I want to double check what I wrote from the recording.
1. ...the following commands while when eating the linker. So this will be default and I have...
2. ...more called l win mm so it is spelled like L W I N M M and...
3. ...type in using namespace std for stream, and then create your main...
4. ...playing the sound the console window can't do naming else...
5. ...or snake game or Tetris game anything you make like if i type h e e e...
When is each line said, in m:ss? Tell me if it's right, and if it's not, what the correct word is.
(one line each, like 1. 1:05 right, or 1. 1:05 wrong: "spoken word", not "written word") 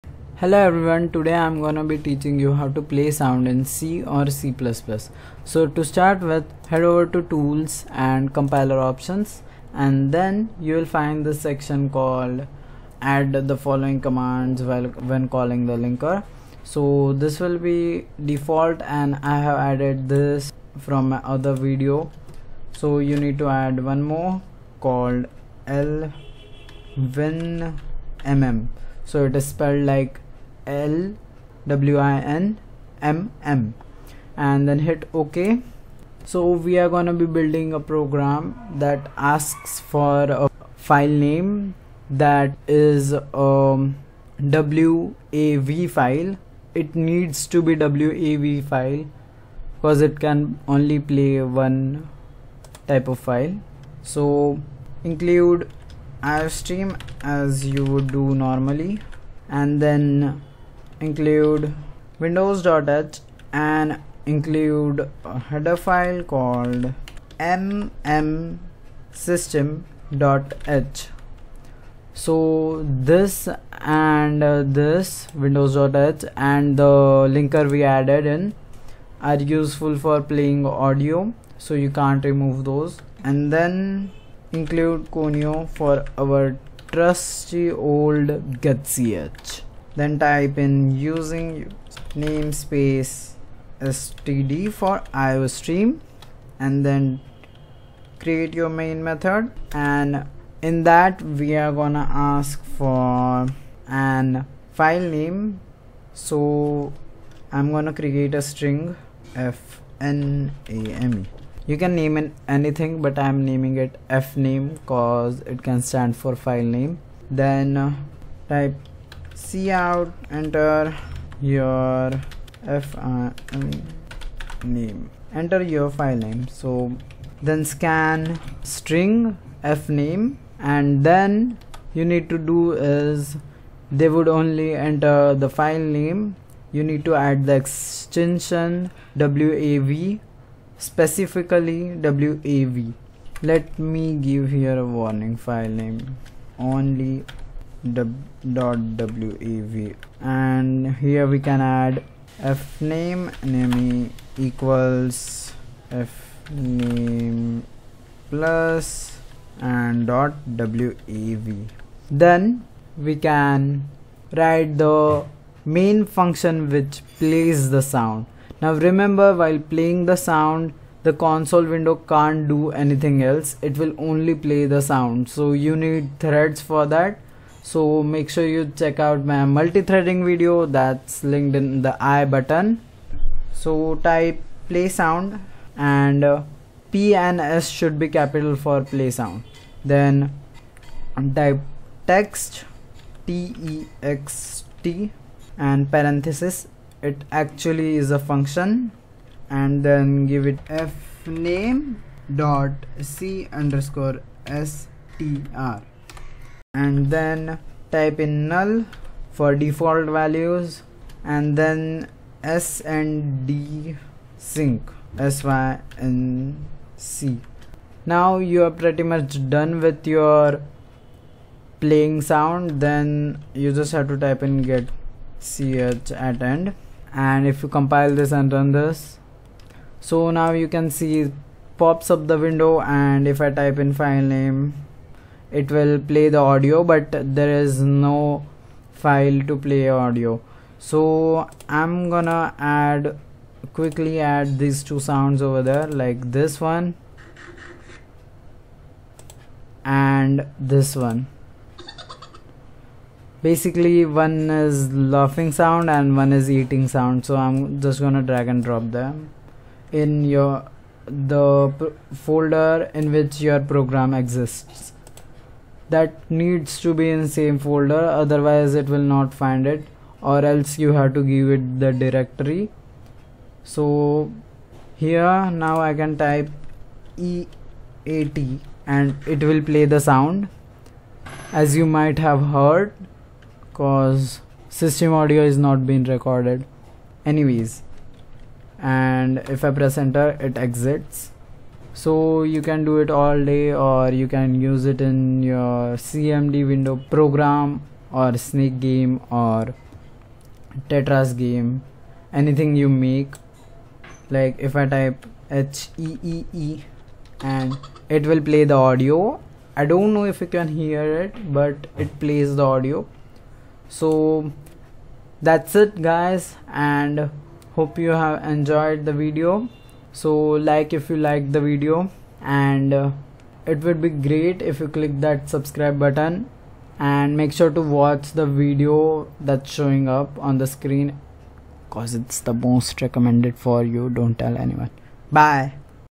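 1. 0:13 wrong: "calling", not "eating"
2. 0:24 right
3. 1:30 right
4. 2:49 wrong: "anything", not "naming"
5. 4:58 right.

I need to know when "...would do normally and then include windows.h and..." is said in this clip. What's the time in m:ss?
0:57.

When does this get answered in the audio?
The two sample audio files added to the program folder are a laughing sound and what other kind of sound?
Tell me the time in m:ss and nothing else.
4:16.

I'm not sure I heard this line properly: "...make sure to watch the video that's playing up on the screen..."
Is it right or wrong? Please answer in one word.
wrong.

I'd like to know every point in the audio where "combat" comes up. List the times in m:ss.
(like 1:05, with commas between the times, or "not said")
not said.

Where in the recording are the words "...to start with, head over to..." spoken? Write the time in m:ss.
0:05.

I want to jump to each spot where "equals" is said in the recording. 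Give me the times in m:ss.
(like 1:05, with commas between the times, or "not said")
2:34.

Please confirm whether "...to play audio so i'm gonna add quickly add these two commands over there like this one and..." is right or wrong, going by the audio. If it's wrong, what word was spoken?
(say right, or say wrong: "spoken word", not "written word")
wrong: "sounds", not "commands".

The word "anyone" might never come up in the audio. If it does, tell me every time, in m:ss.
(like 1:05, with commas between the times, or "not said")
5:34.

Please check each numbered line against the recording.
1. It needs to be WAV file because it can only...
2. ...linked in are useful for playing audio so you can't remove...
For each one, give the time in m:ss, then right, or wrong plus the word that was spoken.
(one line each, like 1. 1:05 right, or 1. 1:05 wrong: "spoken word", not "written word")
1. 0:46 right
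2. 1:17 wrong: "added", not "linked".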